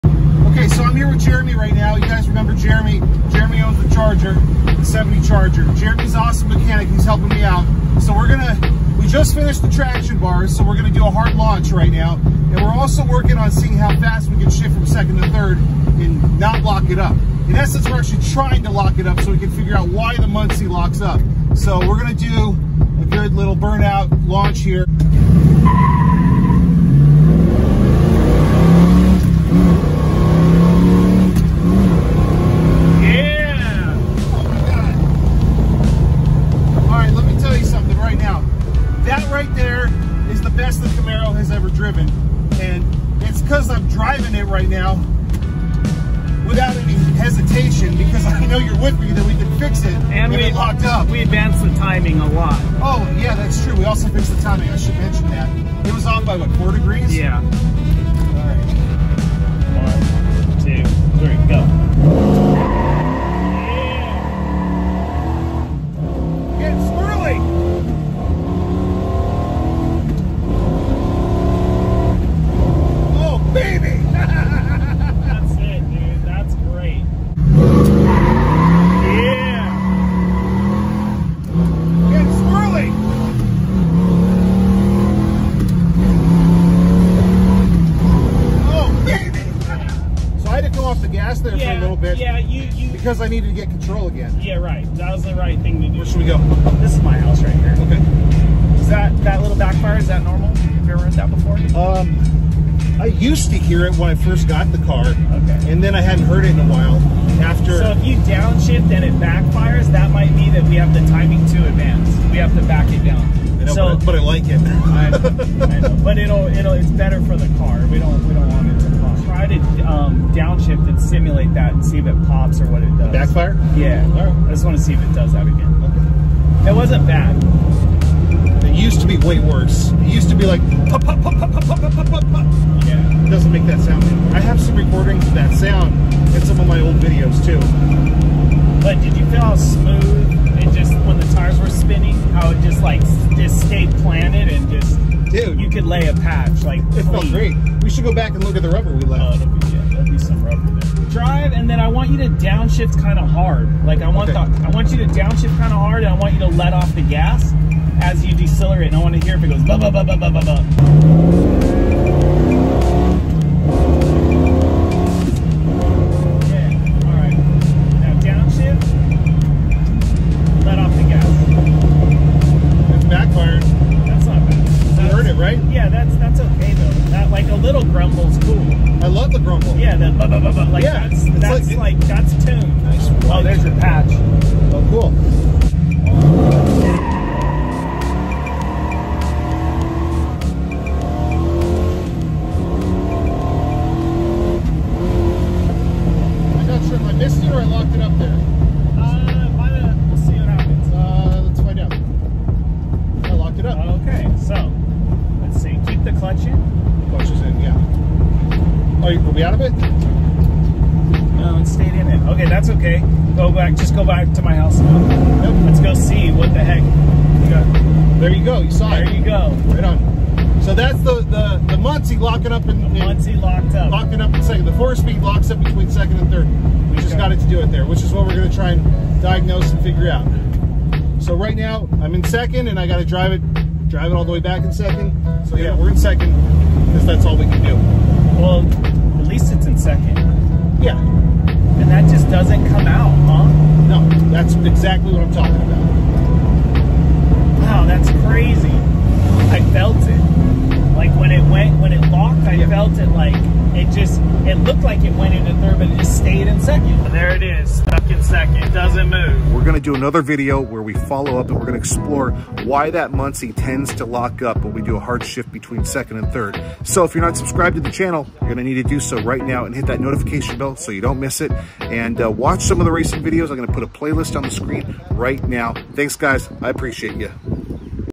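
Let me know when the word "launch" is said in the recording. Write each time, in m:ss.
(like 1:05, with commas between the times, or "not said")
0:11, 0:24.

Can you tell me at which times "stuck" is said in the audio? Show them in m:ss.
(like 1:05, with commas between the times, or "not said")
4:17.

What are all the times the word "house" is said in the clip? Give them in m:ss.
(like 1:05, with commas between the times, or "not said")
1:37, 3:34.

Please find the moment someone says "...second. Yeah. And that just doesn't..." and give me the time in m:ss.
3:59.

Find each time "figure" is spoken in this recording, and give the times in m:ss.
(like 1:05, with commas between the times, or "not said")
0:19, 3:49.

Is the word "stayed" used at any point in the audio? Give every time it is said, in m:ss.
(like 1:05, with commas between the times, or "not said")
2:23, 3:31, 4:16.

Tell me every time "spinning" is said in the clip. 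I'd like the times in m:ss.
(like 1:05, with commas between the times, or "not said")
2:21.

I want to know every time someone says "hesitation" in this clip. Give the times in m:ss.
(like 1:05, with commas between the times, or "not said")
0:47.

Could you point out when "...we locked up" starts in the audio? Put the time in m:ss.
0:50.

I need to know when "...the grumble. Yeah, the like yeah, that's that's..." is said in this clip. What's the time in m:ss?
2:59.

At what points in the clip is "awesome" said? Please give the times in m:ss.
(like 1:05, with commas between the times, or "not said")
0:06.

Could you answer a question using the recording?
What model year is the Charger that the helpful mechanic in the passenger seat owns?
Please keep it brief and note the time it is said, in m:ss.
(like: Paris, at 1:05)
70, at 0:04.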